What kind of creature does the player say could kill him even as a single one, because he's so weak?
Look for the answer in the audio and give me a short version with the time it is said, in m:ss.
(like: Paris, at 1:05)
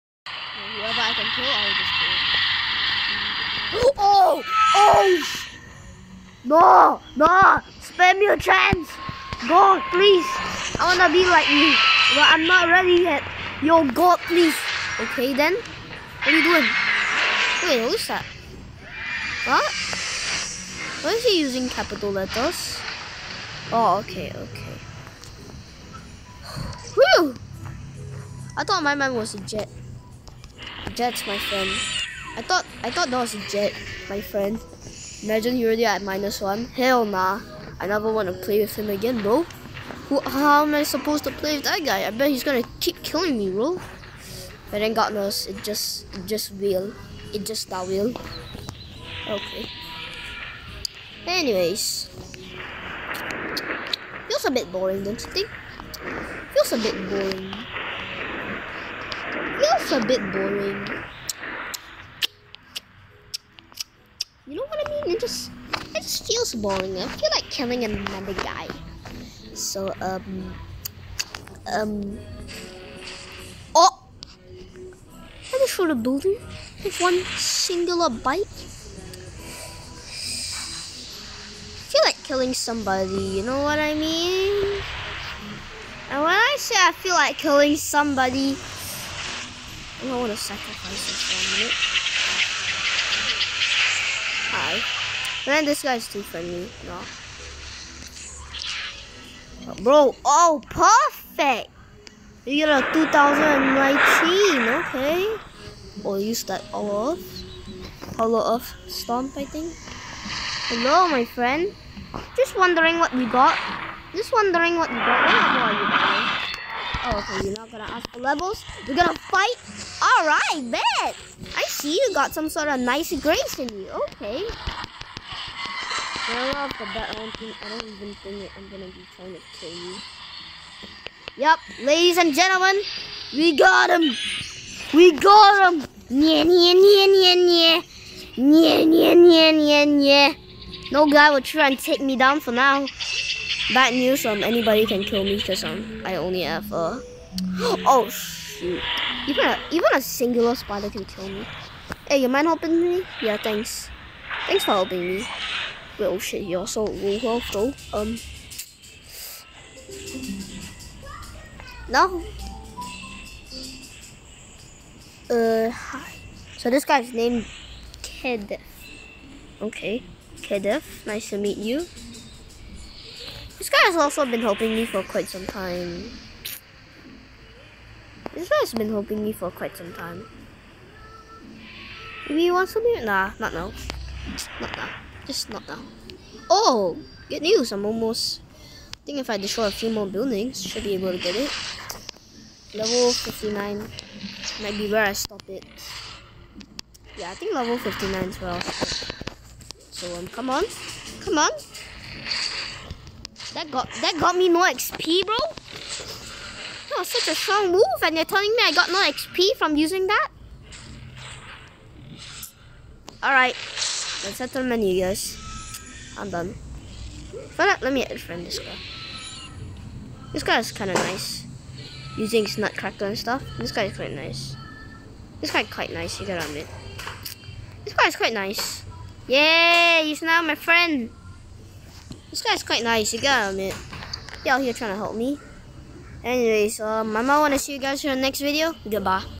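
Spider, at 2:30.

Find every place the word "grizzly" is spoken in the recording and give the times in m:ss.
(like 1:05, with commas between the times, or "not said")
not said.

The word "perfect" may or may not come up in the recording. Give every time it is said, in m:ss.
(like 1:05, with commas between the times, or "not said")
1:40.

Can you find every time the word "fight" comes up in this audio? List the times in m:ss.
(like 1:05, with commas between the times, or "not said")
1:59.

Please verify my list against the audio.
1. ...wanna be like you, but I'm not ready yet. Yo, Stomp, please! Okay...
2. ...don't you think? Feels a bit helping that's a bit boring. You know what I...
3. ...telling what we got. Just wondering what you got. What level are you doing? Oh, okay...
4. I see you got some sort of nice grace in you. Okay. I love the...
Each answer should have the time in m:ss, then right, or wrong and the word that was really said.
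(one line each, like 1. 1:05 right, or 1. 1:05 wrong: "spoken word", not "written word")
1. 0:10 wrong: "God", not "Stomp"
2. 0:55 wrong: "boring", not "helping"
3. 1:52 wrong: "wondering", not "telling"
4. 2:01 right.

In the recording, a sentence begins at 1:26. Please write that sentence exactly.
And when I say I feel like killing somebody I want to sacrifice this for a minute.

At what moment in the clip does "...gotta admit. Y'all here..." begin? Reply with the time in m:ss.
3:53.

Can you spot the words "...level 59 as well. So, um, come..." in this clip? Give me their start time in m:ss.
3:17.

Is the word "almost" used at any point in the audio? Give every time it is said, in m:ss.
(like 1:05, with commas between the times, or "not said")
3:07.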